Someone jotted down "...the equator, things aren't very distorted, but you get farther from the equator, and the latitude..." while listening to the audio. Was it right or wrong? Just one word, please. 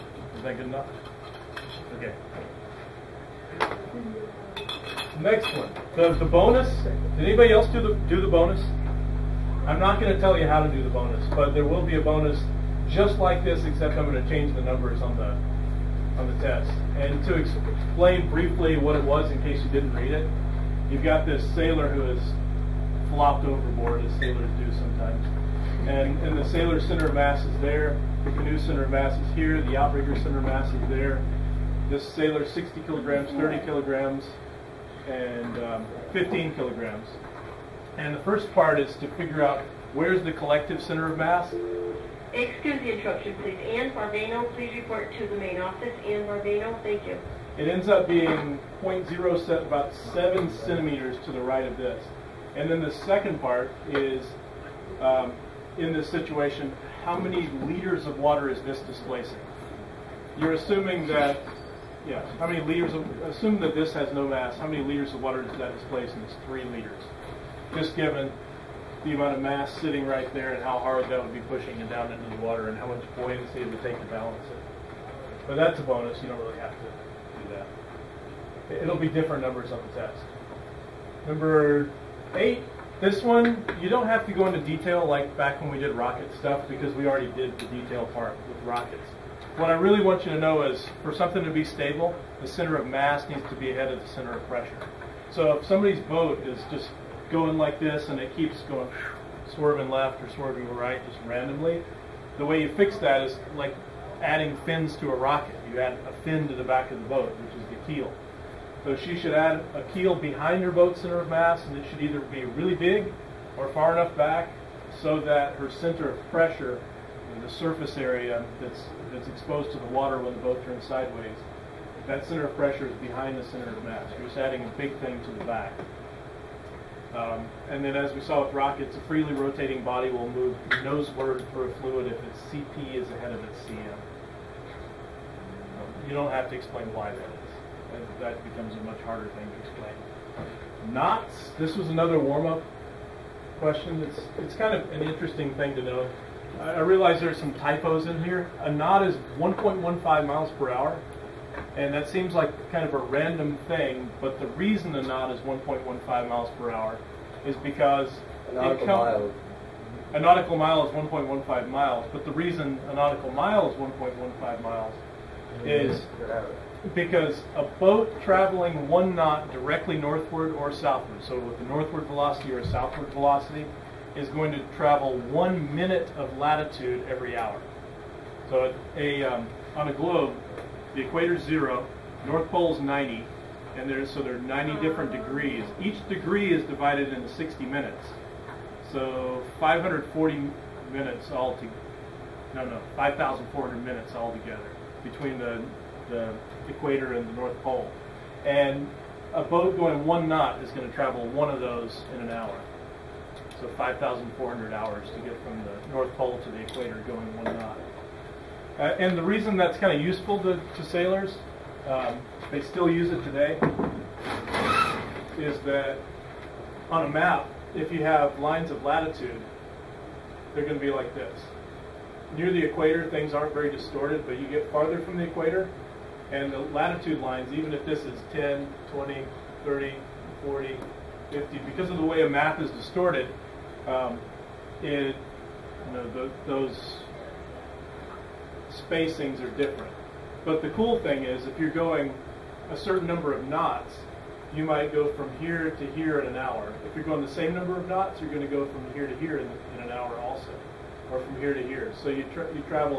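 right.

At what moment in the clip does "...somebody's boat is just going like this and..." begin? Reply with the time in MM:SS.
01:35.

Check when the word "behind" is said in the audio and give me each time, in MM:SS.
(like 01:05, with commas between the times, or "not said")
01:50, 02:02.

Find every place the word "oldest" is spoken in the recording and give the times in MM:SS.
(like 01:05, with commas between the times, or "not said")
not said.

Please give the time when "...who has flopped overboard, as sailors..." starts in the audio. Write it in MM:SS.
00:21.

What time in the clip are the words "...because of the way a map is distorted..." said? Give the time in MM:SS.
03:51.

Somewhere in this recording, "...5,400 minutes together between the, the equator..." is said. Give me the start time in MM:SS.
03:12.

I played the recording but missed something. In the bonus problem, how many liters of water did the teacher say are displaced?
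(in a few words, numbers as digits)
3 liters.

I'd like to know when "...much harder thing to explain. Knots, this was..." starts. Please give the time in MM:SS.
02:18.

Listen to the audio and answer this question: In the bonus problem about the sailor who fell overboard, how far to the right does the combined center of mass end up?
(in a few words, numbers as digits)
7 centimeters.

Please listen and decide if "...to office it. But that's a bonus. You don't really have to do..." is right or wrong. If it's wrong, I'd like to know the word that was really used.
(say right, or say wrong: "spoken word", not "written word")
wrong: "balance", not "office".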